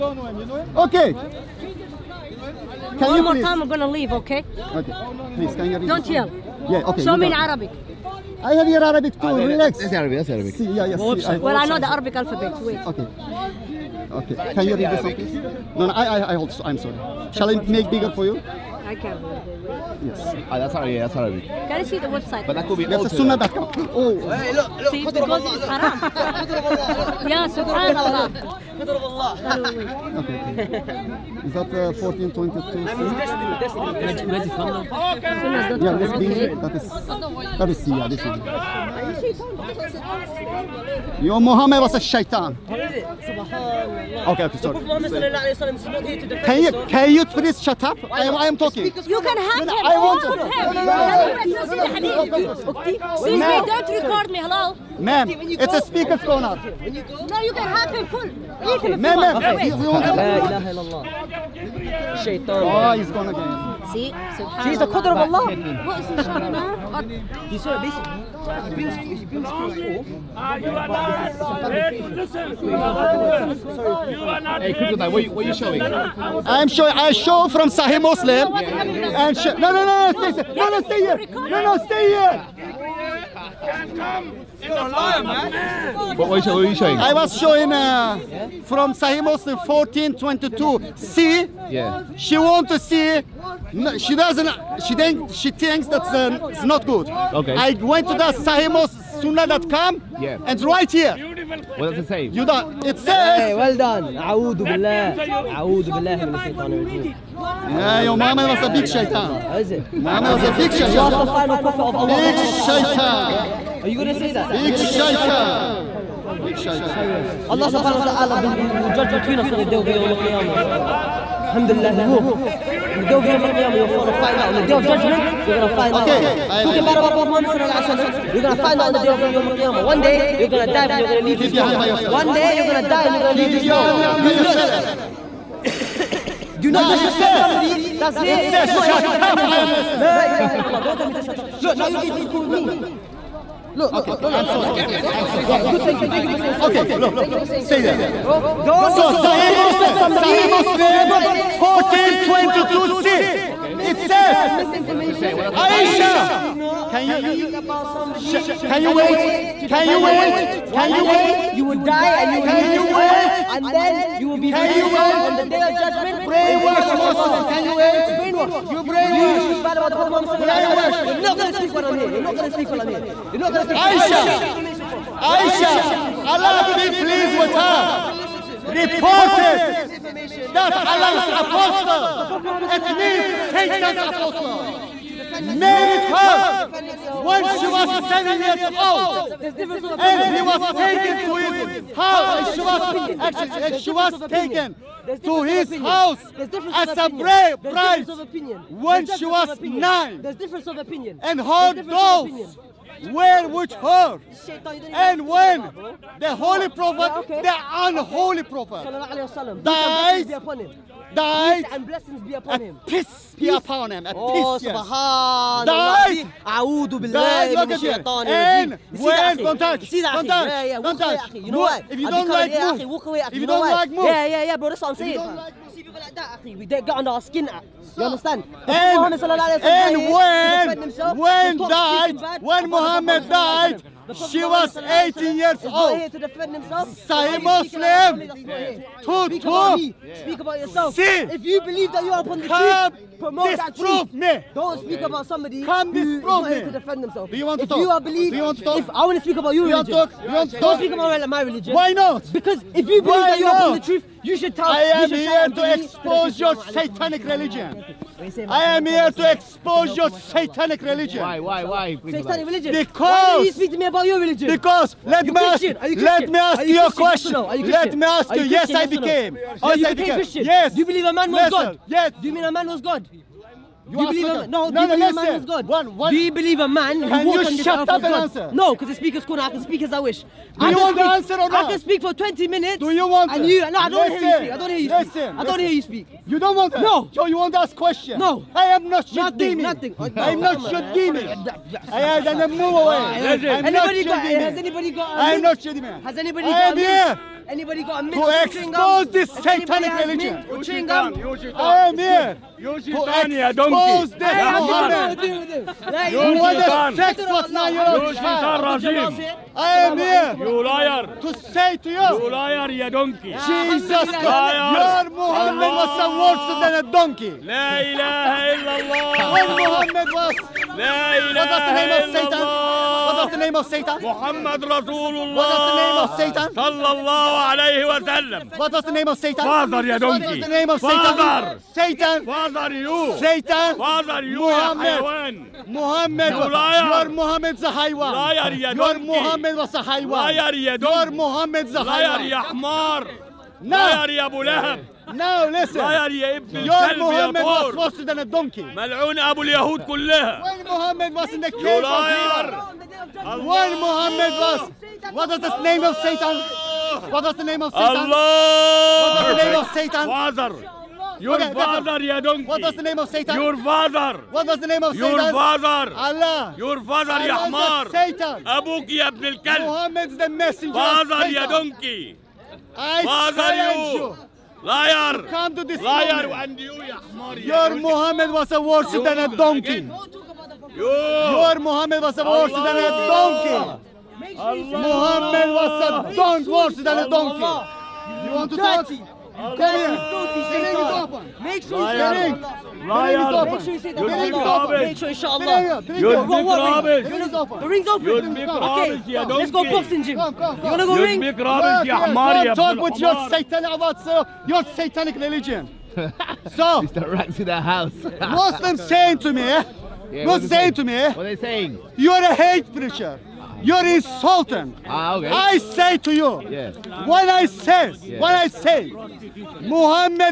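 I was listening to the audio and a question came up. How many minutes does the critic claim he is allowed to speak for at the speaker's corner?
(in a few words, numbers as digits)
20 minutes.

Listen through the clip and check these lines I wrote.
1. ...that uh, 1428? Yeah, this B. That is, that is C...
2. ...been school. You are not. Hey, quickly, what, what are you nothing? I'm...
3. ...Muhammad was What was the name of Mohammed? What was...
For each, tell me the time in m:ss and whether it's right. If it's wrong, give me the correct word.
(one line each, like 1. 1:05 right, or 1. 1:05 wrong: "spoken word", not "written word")
1. 0:31 wrong: "1422", not "1428"
2. 1:09 wrong: "showing", not "nothing"
3. 5:53 wrong: "Satan", not "Mohammed".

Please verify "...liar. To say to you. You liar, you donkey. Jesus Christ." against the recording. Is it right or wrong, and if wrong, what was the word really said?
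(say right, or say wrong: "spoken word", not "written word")
right.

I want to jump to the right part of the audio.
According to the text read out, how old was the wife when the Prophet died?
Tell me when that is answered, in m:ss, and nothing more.
3:54.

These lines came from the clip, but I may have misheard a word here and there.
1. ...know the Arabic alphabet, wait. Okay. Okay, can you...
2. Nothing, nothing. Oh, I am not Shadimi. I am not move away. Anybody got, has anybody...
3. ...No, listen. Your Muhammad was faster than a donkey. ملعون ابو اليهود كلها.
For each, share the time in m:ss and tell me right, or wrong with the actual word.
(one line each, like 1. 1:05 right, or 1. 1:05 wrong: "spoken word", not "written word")
1. 0:11 right
2. 4:49 right
3. 5:45 right.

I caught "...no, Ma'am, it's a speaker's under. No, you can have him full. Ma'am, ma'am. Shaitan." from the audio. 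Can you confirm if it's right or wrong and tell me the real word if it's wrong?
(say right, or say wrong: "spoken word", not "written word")
wrong: "corner", not "under".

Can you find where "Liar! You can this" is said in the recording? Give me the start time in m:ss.
6:14.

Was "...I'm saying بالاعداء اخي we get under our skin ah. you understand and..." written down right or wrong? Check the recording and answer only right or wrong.
right.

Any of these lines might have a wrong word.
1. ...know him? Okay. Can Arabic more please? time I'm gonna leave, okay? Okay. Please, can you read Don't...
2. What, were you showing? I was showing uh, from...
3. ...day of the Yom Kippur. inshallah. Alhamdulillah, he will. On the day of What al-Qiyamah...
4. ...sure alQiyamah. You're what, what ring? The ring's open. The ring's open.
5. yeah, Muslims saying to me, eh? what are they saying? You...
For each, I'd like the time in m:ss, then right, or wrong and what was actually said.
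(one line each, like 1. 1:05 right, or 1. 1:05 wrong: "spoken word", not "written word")
1. 0:00 wrong: "One", not "Arabic"
2. 1:26 right
3. 1:59 wrong: "Yawm", not "What"
4. 6:34 wrong: "inshallah", not "alQiyamah"
5. 6:50 right.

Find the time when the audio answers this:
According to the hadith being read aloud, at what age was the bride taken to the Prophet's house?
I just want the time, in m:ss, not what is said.
3:19.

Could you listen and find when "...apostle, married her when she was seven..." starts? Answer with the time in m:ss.
3:04.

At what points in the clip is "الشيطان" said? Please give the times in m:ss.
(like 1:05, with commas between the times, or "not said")
1:46, 3:37.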